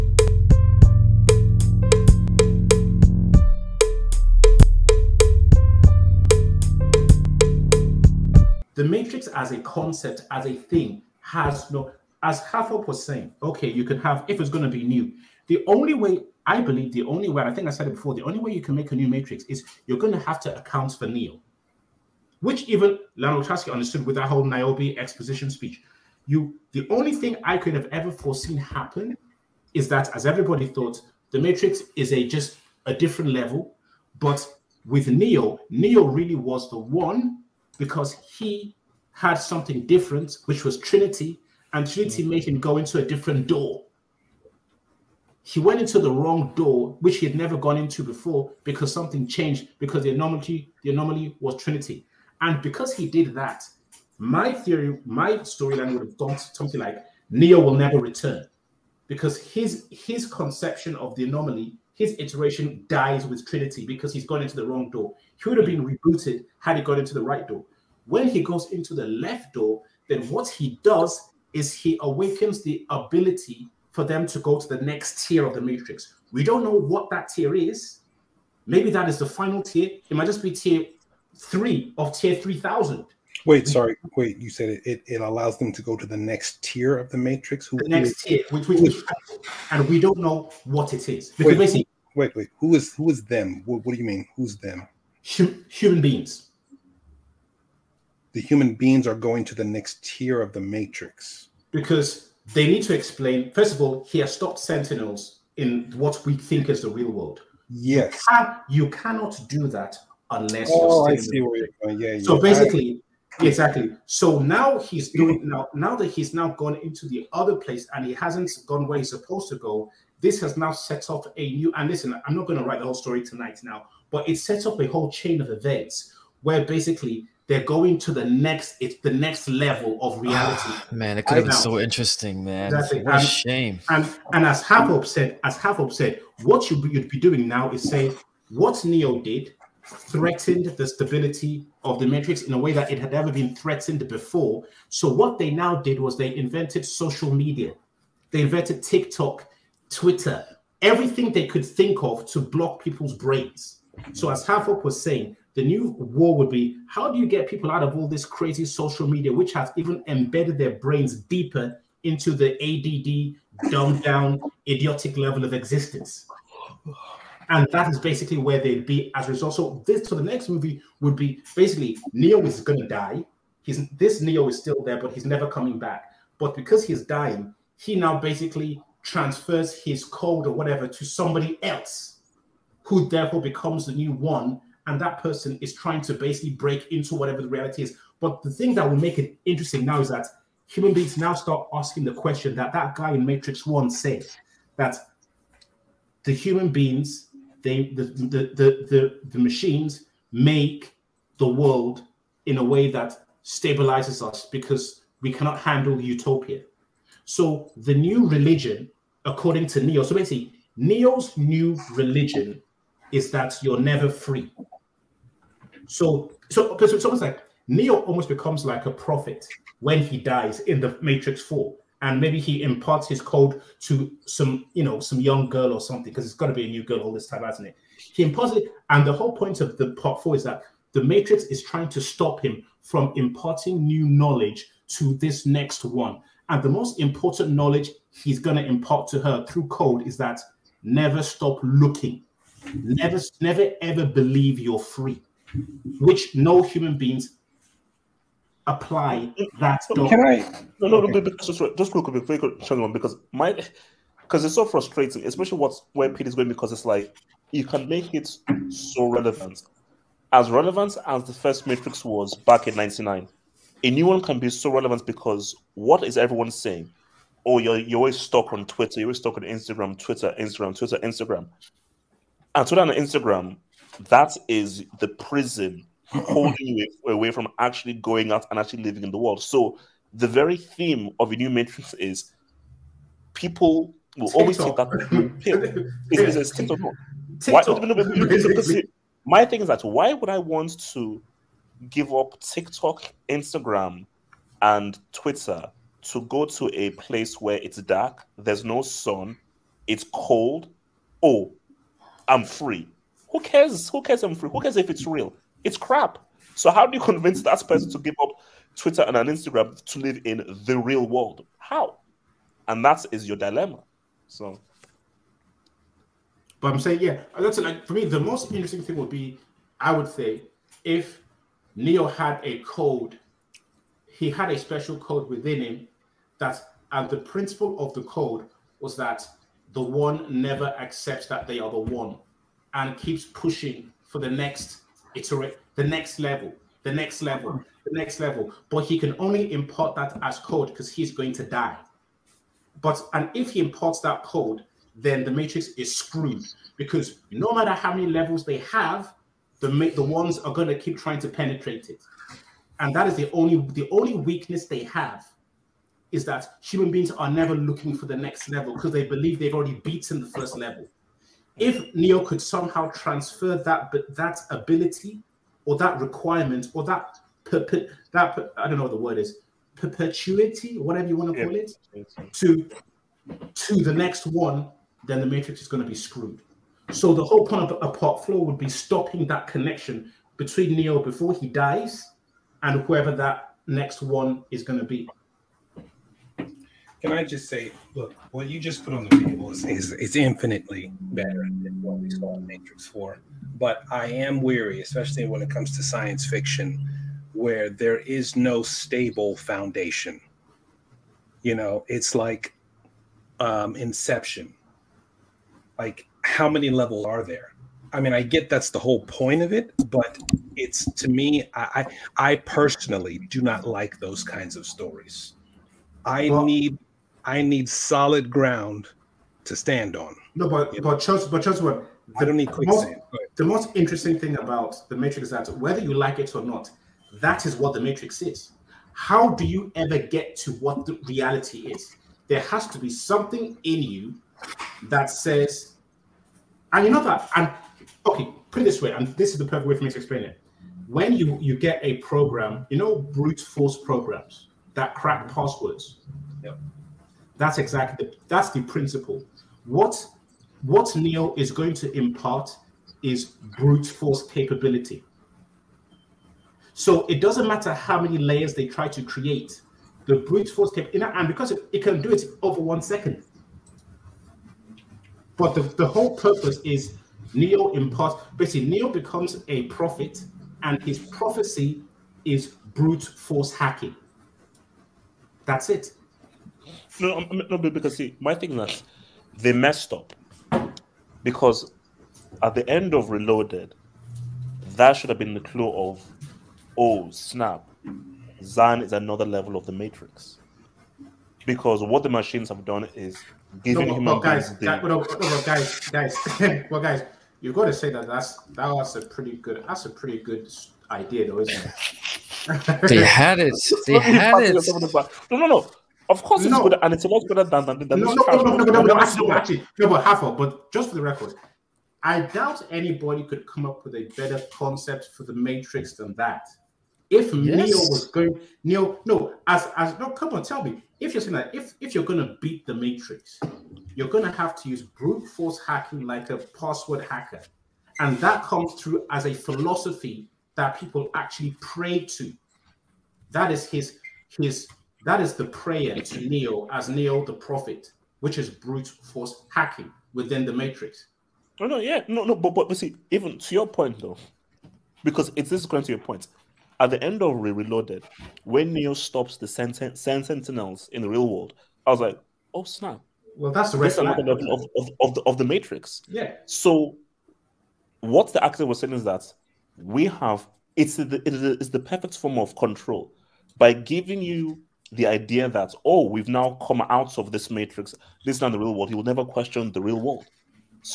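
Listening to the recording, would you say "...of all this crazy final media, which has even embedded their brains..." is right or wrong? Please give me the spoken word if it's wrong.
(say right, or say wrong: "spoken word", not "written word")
wrong: "social", not "final".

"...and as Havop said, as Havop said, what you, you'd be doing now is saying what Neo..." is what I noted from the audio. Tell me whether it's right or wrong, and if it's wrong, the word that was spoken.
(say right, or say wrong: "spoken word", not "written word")
right.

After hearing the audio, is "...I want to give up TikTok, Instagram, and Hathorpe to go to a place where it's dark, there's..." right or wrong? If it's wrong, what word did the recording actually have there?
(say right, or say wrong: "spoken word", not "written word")
wrong: "Twitter", not "Hathorpe".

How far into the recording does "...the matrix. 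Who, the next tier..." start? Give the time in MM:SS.
01:27.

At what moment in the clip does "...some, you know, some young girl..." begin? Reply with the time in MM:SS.
03:44.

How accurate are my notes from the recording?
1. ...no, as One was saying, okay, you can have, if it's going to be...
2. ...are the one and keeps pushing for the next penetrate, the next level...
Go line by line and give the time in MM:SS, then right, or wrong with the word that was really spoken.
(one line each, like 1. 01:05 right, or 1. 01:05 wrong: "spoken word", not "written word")
1. 00:11 wrong: "Hathorpe", not "One"
2. 05:31 wrong: "iterate", not "penetrate".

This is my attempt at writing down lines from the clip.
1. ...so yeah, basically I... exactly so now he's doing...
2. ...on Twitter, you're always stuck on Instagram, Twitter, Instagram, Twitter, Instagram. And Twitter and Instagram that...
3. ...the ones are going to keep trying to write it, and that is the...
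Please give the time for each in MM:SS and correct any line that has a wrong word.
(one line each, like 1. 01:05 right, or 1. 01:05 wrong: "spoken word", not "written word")
1. 01:52 right
2. 04:28 right
3. 05:49 wrong: "penetrate", not "write".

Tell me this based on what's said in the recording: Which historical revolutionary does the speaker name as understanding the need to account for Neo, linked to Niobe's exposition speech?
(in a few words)
Lionel Trotsky.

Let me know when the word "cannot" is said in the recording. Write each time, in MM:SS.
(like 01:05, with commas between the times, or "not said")
01:48, 03:25.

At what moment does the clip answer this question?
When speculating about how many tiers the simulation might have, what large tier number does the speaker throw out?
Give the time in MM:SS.
01:22.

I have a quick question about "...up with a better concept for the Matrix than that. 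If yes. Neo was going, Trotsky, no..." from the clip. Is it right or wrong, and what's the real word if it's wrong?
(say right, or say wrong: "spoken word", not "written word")
wrong: "Neo", not "Trotsky".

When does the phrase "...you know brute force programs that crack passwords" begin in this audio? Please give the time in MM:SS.
07:22.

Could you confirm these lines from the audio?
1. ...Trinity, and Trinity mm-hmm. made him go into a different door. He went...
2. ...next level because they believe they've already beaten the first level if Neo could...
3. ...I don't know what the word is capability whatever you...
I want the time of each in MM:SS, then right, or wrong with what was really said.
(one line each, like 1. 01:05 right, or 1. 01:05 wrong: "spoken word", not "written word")
1. 00:40 right
2. 05:58 right
3. 06:08 wrong: "perpetuity", not "capability".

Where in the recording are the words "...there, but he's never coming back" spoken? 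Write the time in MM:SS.
02:54.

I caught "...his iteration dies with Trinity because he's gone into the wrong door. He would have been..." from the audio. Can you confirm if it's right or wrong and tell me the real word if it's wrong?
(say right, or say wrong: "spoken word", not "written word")
right.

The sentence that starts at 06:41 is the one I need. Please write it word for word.
You know, it's like um, Inception.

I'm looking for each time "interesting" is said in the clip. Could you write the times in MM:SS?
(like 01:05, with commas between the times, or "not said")
02:11, 03:09, 05:18, 07:03.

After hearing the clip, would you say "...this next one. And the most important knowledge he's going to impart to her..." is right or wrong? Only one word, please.
right.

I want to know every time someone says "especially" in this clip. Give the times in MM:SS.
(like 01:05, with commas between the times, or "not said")
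04:15, 06:34.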